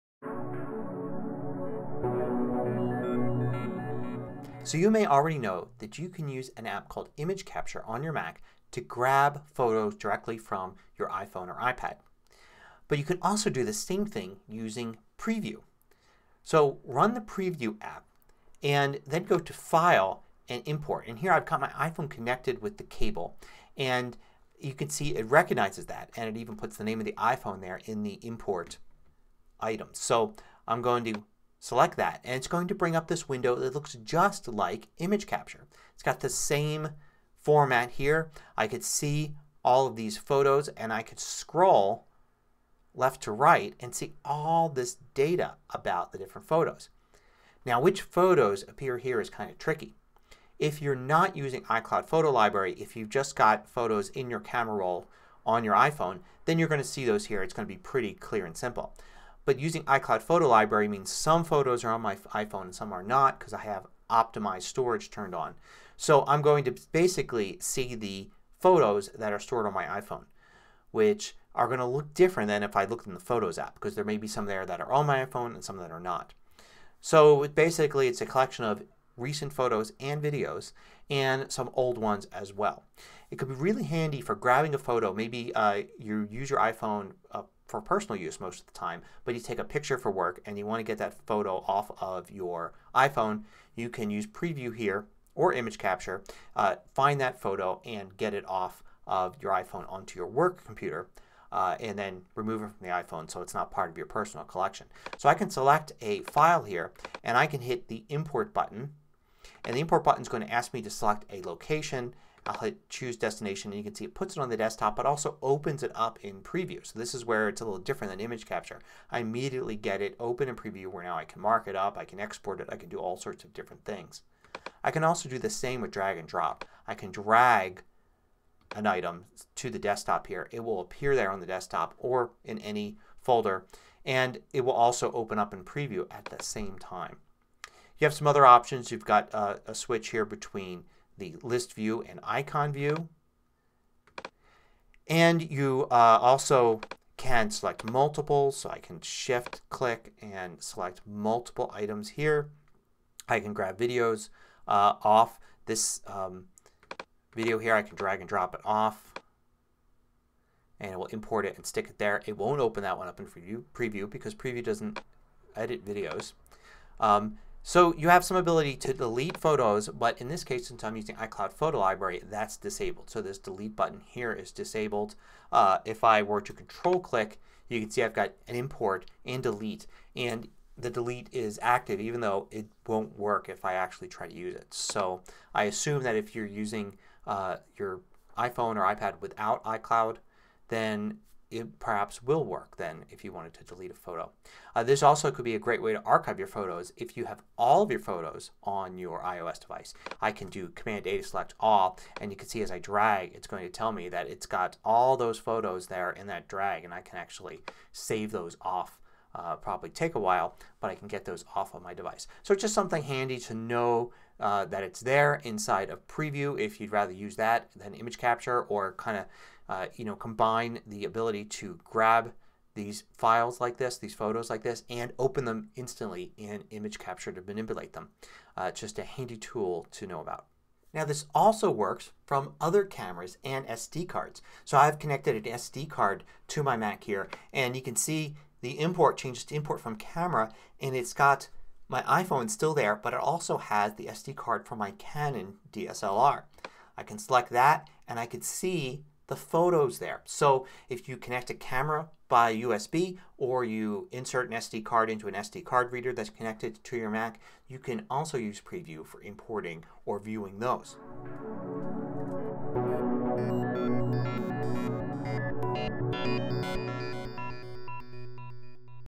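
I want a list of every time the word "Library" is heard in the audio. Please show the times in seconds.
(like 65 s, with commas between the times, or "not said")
52 s, 60 s, 171 s.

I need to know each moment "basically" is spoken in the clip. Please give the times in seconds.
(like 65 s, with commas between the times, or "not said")
66 s, 77 s.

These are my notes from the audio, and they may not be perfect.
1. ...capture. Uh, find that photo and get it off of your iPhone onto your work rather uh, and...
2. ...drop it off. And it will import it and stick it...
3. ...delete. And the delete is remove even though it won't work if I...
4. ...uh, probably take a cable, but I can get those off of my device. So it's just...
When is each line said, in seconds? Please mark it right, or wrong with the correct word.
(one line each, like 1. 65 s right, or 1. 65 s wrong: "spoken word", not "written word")
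1. 95 s wrong: "computer", not "rather"
2. 158 s right
3. 179 s wrong: "active", not "remove"
4. 209 s wrong: "while", not "cable".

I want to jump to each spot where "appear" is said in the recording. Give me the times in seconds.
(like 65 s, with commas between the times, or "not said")
48 s, 130 s.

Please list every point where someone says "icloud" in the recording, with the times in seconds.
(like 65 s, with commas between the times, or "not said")
51 s, 59 s, 171 s, 189 s.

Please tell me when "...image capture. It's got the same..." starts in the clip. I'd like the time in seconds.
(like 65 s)
34 s.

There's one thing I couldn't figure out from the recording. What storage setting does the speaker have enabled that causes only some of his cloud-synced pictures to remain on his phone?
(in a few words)
Optimized storage.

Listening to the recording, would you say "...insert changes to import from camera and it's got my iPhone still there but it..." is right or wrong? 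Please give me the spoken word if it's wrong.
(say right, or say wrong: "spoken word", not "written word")
wrong: "import", not "insert".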